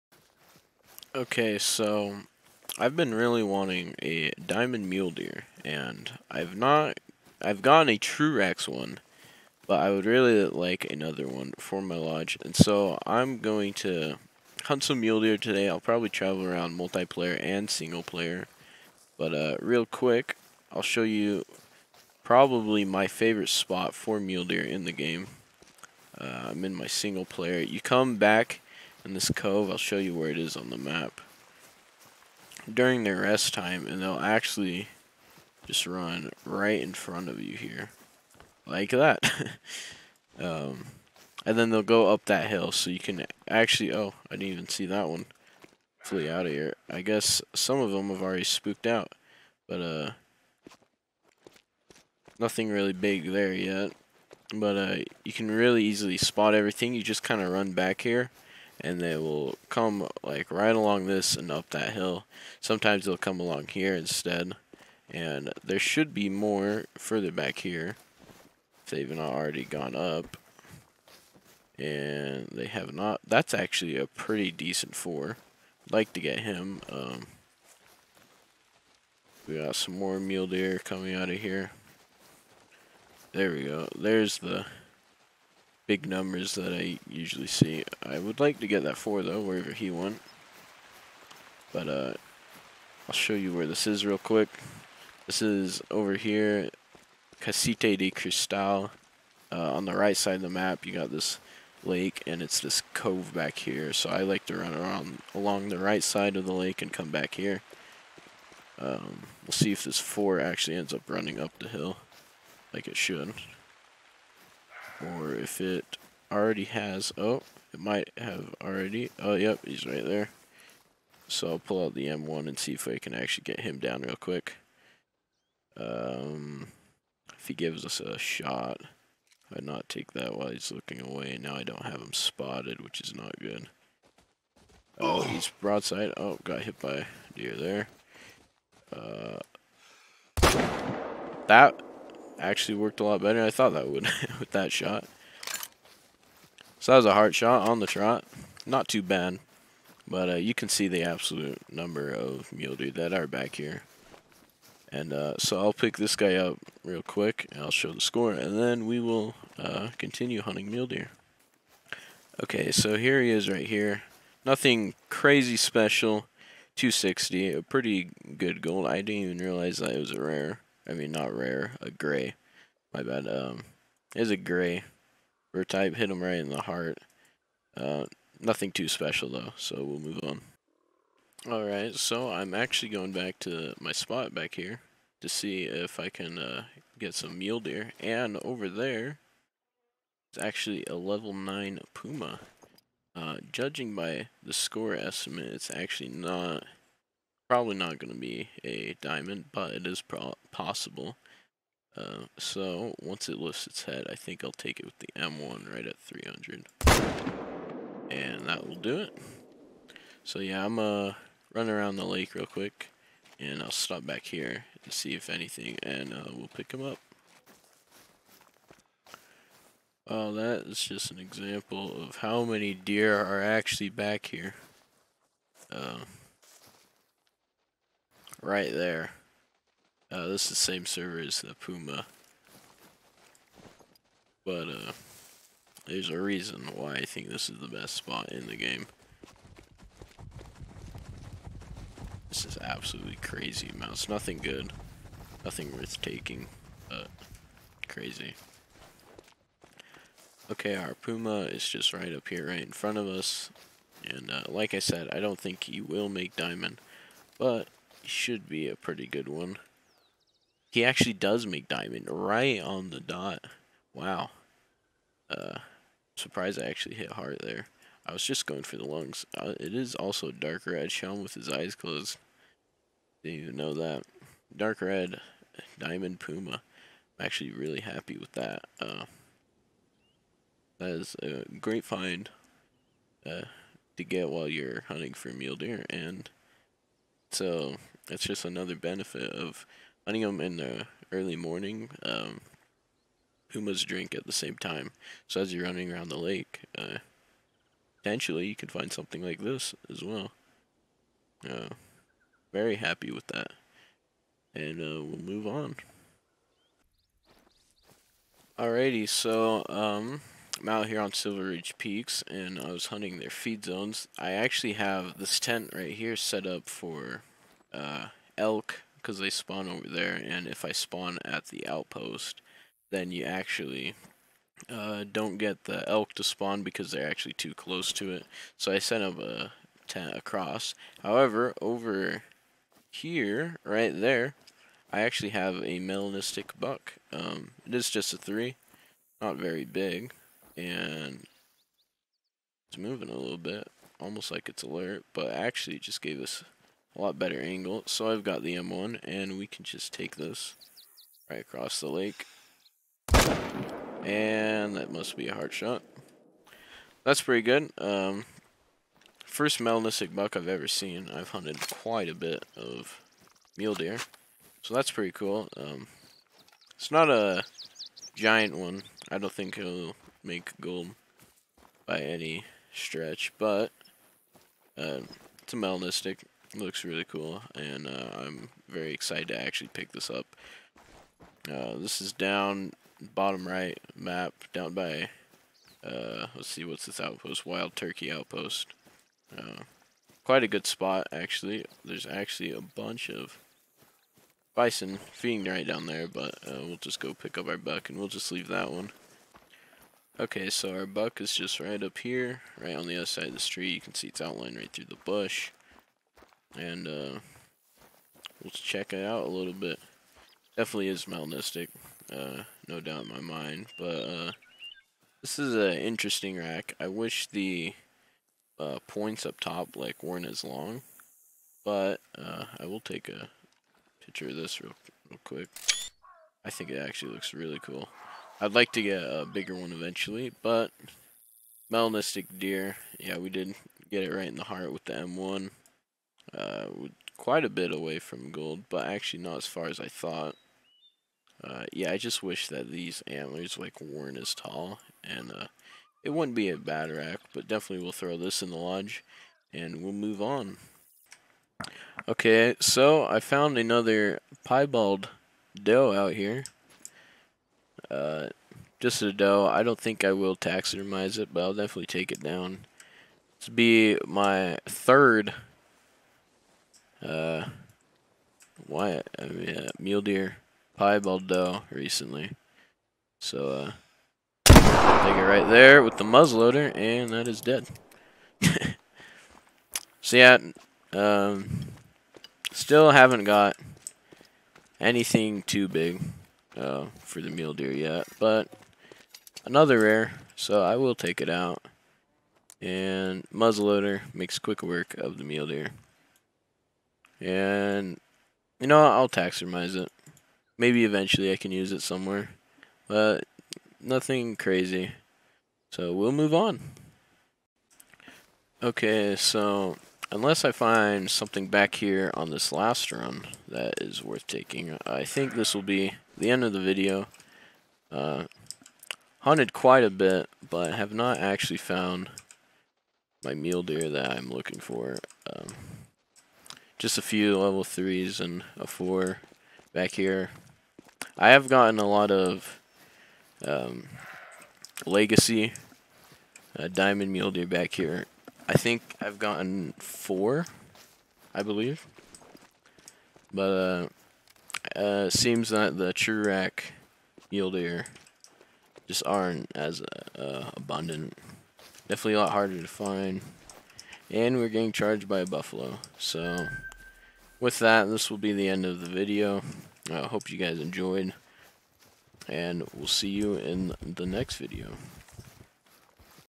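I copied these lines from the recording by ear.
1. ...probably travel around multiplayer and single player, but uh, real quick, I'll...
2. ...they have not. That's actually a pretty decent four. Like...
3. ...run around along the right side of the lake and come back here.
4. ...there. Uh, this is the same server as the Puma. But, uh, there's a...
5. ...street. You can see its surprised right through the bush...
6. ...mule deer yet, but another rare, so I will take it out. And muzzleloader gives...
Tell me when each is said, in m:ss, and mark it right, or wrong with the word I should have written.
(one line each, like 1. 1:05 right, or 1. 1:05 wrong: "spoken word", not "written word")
1. 0:15 right
2. 1:12 right
3. 1:44 right
4. 3:48 right
5. 6:43 wrong: "outlined", not "surprised"
6. 8:07 wrong: "makes", not "gives".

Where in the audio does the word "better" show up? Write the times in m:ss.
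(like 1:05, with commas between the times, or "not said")
2:23, 5:47.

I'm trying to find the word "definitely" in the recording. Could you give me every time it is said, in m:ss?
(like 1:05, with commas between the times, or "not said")
6:50, 7:27, 7:41, 9:11.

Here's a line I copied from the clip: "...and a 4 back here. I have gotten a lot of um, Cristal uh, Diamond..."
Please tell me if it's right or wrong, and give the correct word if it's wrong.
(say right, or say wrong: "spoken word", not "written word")
wrong: "Legacy", not "Cristal".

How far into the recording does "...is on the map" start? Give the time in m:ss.
0:30.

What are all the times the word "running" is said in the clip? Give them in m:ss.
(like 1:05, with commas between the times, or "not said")
1:51, 4:55.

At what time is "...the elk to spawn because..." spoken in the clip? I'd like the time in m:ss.
5:25.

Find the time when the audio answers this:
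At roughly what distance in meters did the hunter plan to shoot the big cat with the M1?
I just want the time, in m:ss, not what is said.
3:25.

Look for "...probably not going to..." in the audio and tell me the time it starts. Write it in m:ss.
3:17.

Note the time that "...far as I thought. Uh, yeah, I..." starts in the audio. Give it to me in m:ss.
7:19.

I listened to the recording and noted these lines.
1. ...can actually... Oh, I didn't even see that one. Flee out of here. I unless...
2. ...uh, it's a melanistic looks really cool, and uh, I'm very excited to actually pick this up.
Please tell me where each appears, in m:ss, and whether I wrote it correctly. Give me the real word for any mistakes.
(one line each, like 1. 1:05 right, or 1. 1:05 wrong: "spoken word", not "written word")
1. 0:42 wrong: "guess", not "unless"
2. 6:14 right.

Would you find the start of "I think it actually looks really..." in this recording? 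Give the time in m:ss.
7:06.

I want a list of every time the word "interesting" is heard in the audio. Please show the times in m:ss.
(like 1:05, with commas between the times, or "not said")
6:55.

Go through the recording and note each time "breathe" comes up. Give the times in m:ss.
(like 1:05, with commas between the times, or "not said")
not said.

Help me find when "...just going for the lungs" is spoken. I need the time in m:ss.
4:28.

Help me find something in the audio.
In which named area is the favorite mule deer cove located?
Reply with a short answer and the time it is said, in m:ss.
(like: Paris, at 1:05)
Casite de Cristal, at 1:37.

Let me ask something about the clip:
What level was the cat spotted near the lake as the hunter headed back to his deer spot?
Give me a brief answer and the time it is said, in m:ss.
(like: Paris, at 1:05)
9, at 3:10.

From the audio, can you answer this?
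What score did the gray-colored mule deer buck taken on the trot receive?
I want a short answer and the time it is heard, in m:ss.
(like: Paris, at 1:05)
260, at 2:46.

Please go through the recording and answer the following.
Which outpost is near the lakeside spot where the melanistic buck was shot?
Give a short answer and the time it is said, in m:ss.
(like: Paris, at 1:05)
Wild Turkey Outpost, at 6:27.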